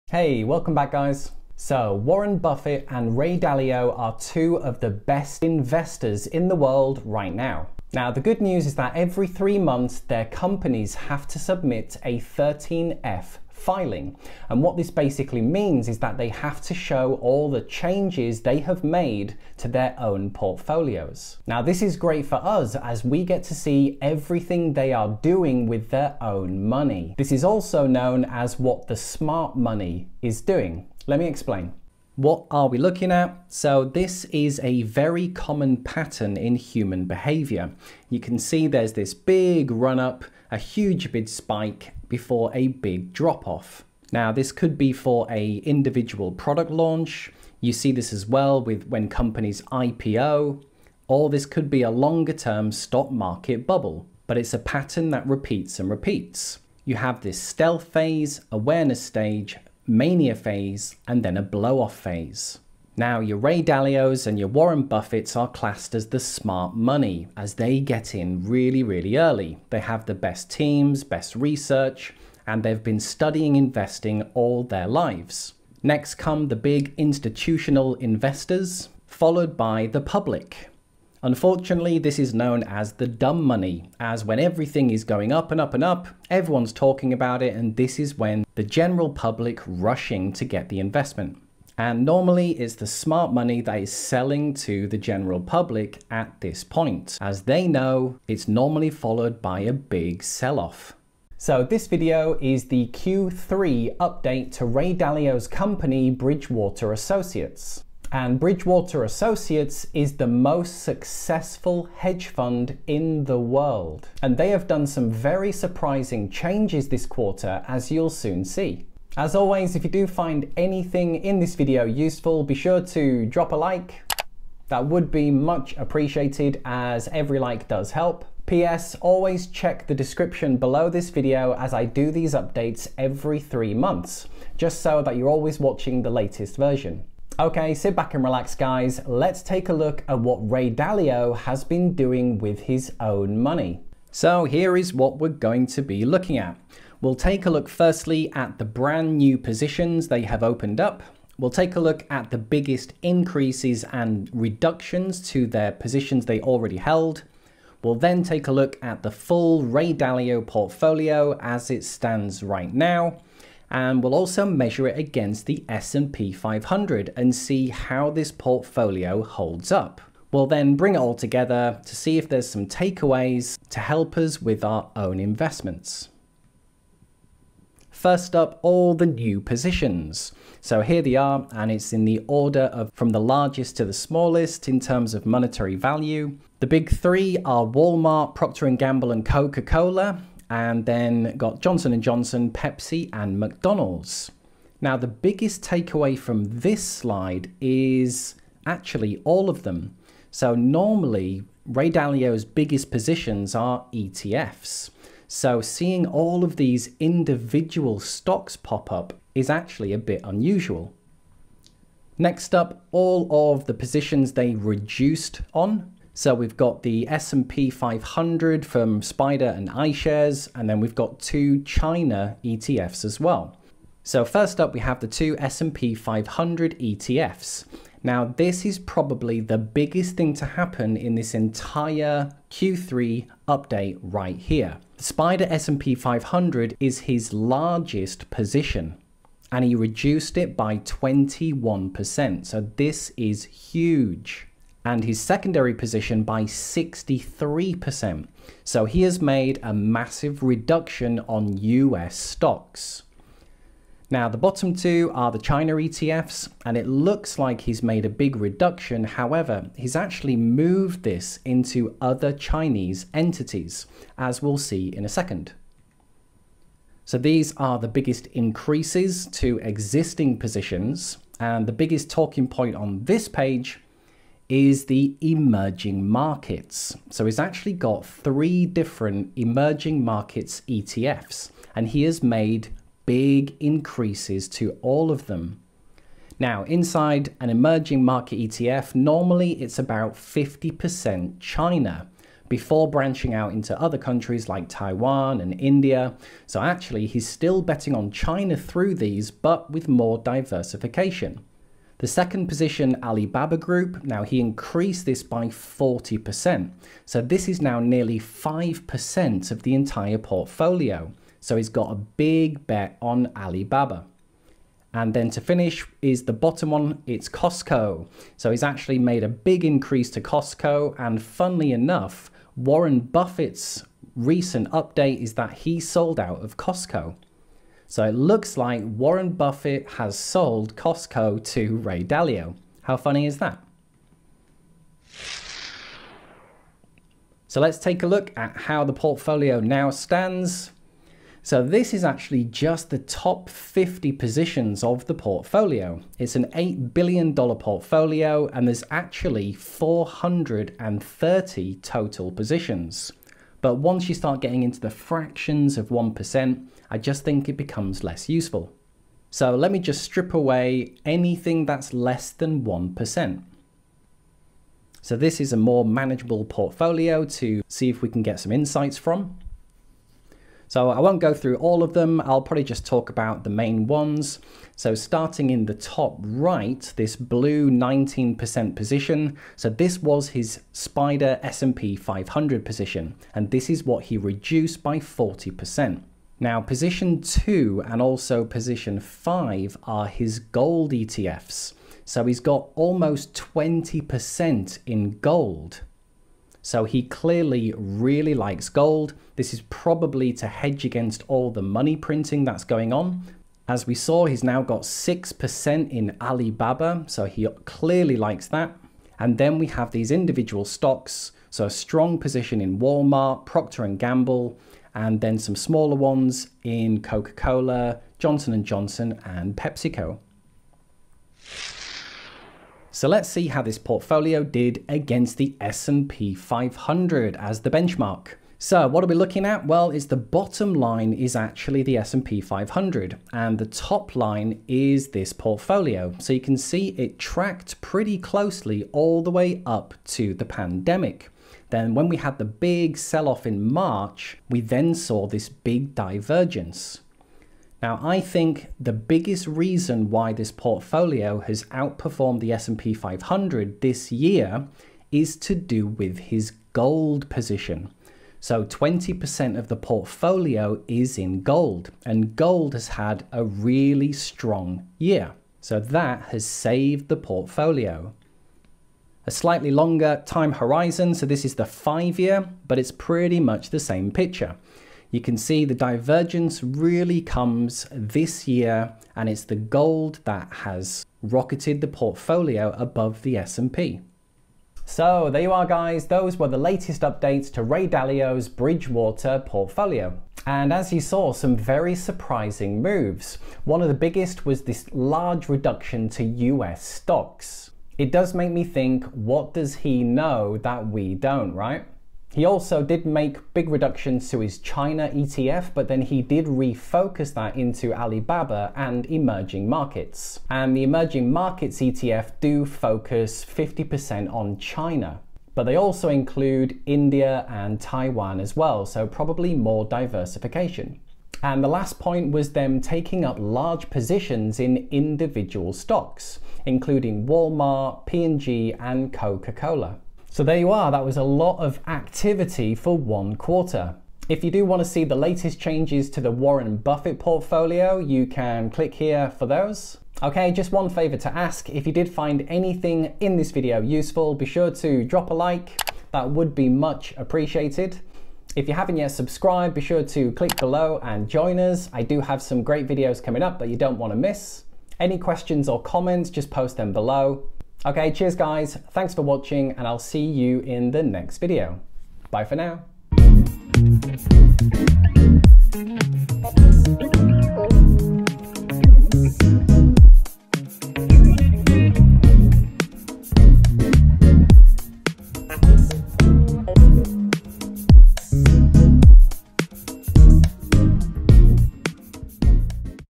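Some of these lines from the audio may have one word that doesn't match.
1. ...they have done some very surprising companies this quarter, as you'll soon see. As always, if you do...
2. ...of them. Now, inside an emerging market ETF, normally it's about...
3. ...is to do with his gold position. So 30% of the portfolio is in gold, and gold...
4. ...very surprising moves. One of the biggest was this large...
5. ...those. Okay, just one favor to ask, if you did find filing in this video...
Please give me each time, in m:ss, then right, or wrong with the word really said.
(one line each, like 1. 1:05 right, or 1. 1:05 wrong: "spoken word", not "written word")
1. 1:54 wrong: "changes", not "companies"
2. 4:45 right
3. 7:35 wrong: "20", not "30"
4. 8:11 right
5. 8:59 wrong: "anything", not "filing".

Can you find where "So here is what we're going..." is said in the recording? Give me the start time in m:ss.
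2:24.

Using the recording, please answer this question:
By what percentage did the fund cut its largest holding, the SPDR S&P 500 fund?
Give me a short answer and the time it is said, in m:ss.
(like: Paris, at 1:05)
21%, at 4:00.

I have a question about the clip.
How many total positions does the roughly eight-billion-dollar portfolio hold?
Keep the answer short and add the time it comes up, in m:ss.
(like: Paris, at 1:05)
430, at 5:49.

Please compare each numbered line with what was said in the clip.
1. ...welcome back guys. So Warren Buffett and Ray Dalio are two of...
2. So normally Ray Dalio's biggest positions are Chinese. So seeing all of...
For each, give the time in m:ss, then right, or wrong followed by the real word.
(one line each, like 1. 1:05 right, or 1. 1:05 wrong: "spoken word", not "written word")
1. 0:00 right
2. 3:20 wrong: "ETFs", not "Chinese".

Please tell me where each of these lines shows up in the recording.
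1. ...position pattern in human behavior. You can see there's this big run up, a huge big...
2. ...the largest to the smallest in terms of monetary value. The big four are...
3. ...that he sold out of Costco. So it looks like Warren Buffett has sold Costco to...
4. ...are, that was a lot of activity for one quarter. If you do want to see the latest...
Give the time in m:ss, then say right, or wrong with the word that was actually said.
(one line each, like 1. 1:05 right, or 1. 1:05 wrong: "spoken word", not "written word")
1. 0:35 wrong: "common", not "position"
2. 3:03 wrong: "three", not "four"
3. 5:25 right
4. 8:50 right.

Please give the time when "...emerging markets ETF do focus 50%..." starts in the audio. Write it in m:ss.
8:30.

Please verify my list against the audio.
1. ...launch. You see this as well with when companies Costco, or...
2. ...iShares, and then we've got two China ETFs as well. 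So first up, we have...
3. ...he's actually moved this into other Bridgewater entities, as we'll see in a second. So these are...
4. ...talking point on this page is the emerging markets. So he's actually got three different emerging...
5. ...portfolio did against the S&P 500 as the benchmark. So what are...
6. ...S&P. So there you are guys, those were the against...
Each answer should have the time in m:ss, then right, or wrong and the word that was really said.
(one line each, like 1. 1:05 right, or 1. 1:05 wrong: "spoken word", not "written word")
1. 0:46 wrong: "IPO", not "Costco"
2. 3:39 right
3. 4:19 wrong: "Chinese", not "Bridgewater"
4. 4:32 right
5. 7:03 right
6. 8:03 wrong: "latest", not "against".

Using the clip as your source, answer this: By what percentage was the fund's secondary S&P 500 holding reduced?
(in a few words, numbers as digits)
63%.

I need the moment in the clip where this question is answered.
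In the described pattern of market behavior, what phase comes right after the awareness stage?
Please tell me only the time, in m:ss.
0:59.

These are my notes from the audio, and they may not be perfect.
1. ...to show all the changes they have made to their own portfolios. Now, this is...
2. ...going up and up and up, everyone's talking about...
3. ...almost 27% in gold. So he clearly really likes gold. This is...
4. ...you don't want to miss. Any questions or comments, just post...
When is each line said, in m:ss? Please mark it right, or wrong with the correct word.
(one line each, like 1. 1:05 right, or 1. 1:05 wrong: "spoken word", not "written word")
1. 0:16 right
2. 1:25 right
3. 6:32 wrong: "20", not "27"
4. 9:13 right.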